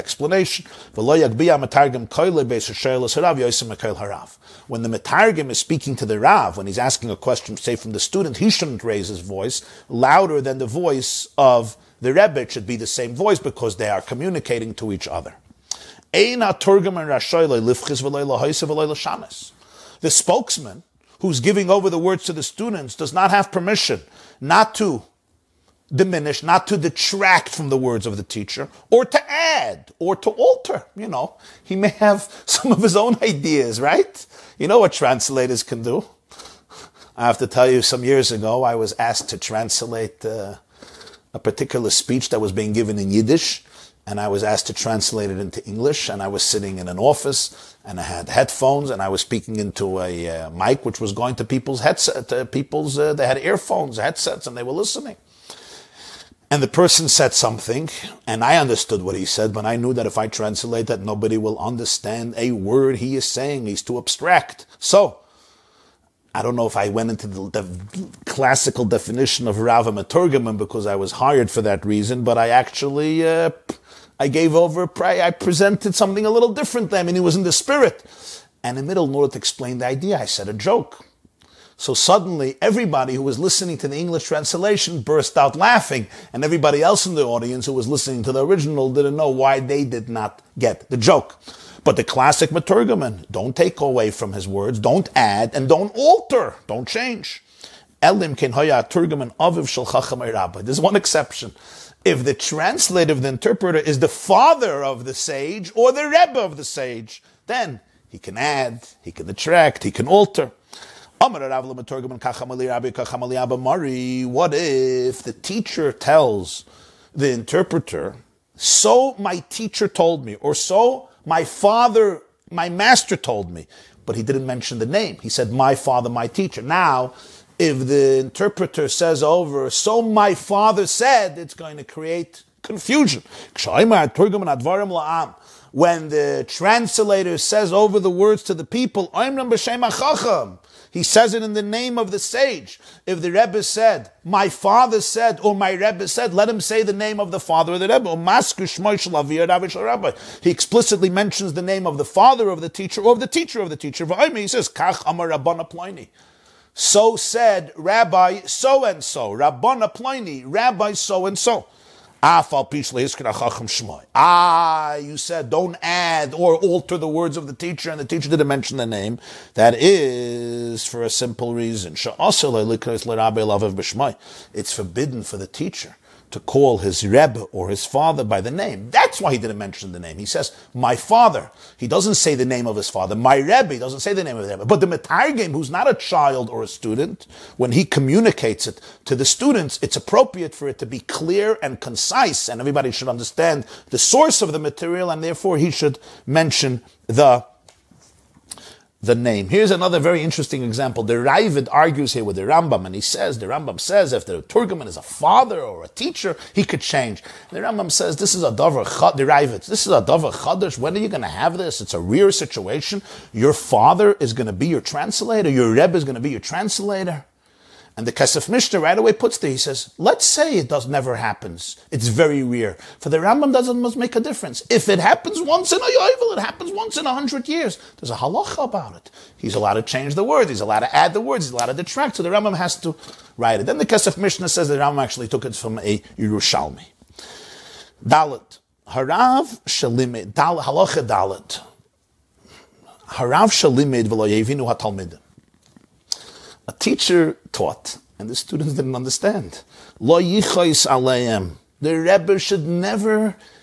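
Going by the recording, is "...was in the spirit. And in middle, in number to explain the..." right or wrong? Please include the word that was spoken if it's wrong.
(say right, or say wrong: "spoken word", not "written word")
wrong: "order", not "number".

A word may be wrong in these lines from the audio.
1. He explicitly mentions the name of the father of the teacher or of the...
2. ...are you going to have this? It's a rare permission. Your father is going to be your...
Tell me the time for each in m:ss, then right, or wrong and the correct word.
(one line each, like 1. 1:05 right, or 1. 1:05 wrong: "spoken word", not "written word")
1. 2:30 right
2. 3:30 wrong: "situation", not "permission".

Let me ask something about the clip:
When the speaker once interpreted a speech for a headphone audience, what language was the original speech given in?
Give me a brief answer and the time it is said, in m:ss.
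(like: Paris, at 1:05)
Yiddish, at 0:43.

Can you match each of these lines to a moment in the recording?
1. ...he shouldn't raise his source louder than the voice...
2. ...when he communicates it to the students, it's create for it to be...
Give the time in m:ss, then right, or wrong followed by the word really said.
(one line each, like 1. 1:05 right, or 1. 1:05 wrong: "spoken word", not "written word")
1. 0:08 wrong: "voice", not "source"
2. 3:07 wrong: "appropriate", not "create".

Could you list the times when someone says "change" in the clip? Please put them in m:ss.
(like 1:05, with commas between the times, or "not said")
1:36, 3:26, 3:49.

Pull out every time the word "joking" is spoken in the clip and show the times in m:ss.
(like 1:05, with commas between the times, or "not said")
not said.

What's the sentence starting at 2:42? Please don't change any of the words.
Ah, you said don't add or alter the words of the teacher, and the teacher didn't mention the name.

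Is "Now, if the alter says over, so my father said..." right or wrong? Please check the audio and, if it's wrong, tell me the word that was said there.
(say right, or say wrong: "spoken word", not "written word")
wrong: "interpreter", not "alter".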